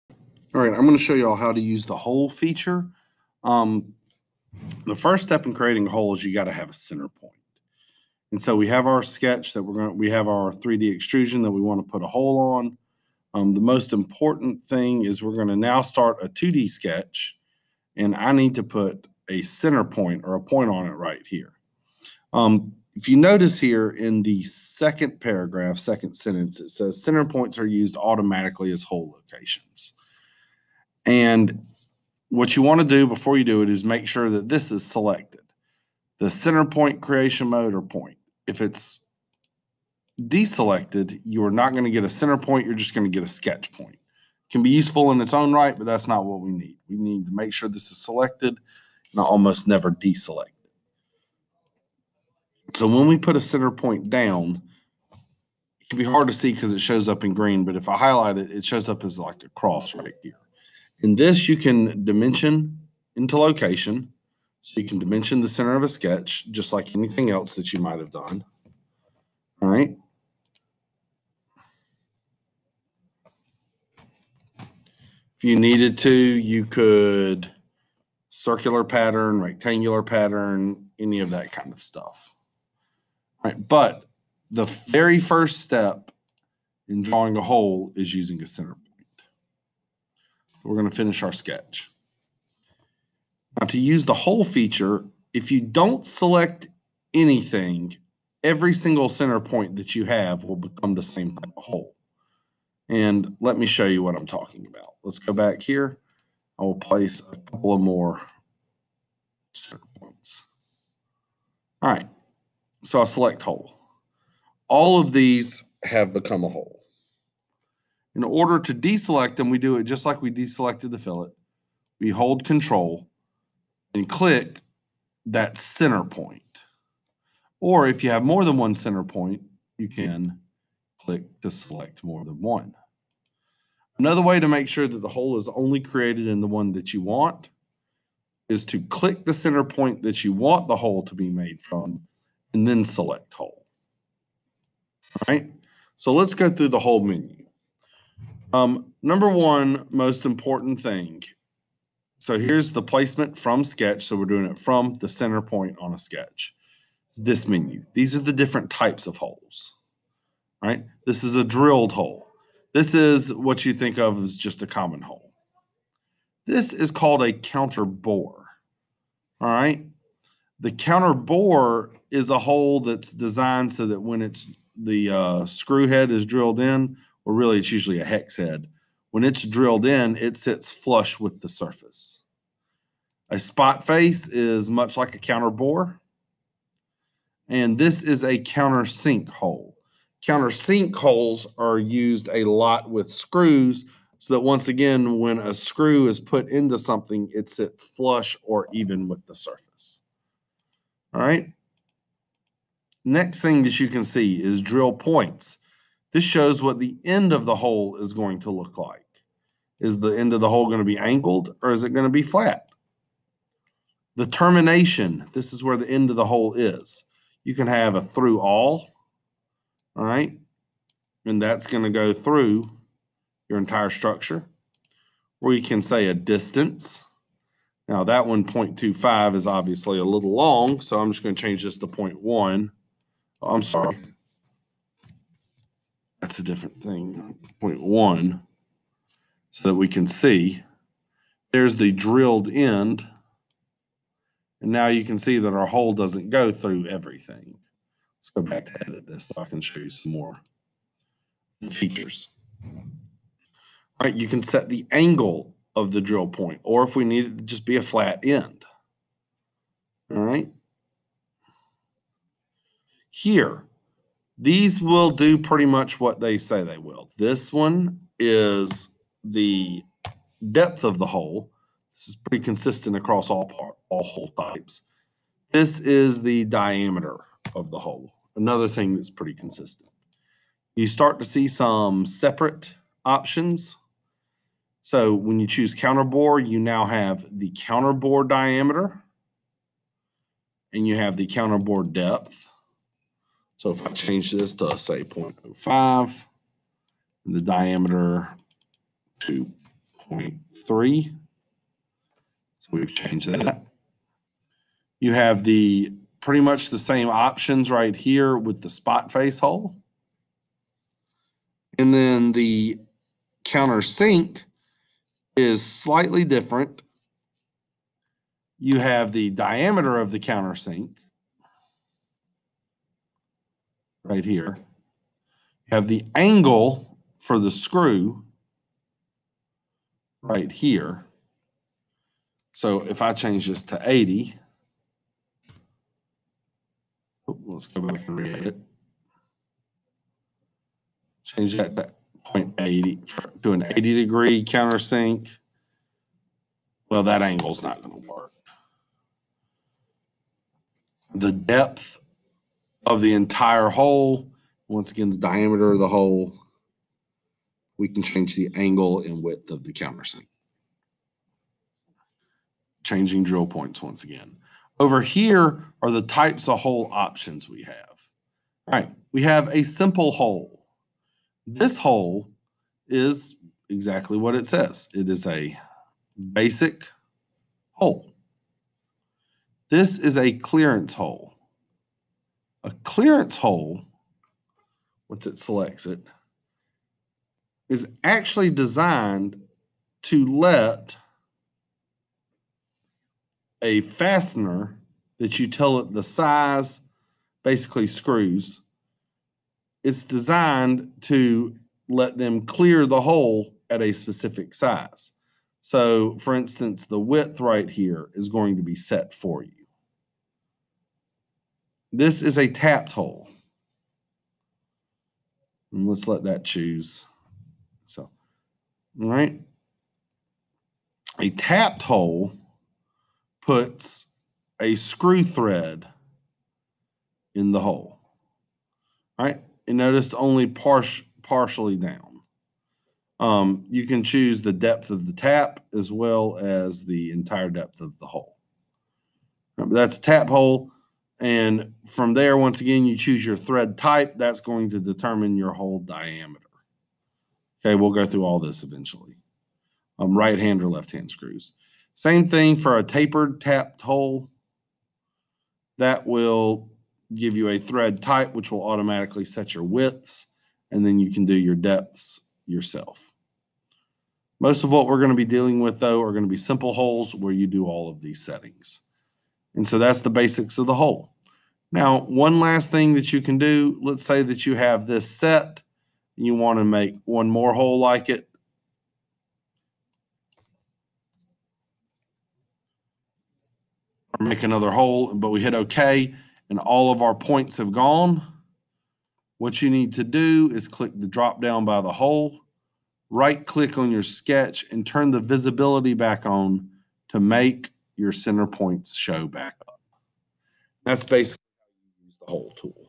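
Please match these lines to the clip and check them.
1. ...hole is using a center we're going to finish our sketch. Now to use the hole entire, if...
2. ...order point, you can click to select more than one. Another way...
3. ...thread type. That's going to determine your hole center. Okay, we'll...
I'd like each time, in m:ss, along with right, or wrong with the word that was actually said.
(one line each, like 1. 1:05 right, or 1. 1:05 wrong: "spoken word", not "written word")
1. 1:27 wrong: "feature", not "entire"
2. 2:08 wrong: "center", not "order"
3. 7:23 wrong: "diameter", not "center".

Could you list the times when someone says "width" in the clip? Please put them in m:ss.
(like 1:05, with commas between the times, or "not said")
5:59, 6:46, 7:39.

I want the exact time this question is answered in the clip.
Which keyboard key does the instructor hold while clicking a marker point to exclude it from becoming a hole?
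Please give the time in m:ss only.
2:02.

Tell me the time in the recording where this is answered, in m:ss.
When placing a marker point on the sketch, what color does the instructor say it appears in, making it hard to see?
0:57.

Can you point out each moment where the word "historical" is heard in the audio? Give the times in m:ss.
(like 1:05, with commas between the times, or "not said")
not said.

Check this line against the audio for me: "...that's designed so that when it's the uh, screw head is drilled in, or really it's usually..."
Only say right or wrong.
right.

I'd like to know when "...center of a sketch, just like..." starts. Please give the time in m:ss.
1:05.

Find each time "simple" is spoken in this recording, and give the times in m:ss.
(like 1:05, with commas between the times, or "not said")
6:09, 7:46.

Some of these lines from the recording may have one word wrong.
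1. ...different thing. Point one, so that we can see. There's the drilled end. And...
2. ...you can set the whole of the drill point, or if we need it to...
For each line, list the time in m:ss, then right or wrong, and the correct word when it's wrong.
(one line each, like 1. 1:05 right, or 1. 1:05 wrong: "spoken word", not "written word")
1. 3:56 right
2. 4:14 wrong: "angle", not "whole".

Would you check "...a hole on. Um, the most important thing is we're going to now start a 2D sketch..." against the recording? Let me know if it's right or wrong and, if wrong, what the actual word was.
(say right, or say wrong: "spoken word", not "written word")
right.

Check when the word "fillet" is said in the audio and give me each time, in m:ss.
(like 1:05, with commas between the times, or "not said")
2:00.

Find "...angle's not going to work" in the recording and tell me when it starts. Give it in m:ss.
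5:47.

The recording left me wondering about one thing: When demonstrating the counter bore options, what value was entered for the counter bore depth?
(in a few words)
0.05.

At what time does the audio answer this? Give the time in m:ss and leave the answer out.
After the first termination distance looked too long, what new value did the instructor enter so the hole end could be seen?
3:51.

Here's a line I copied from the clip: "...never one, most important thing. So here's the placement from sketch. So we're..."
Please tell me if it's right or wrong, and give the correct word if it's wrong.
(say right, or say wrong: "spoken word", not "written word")
wrong: "number", not "never".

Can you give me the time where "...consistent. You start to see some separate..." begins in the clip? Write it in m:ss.
4:39.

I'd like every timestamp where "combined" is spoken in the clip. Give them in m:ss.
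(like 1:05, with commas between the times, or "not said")
not said.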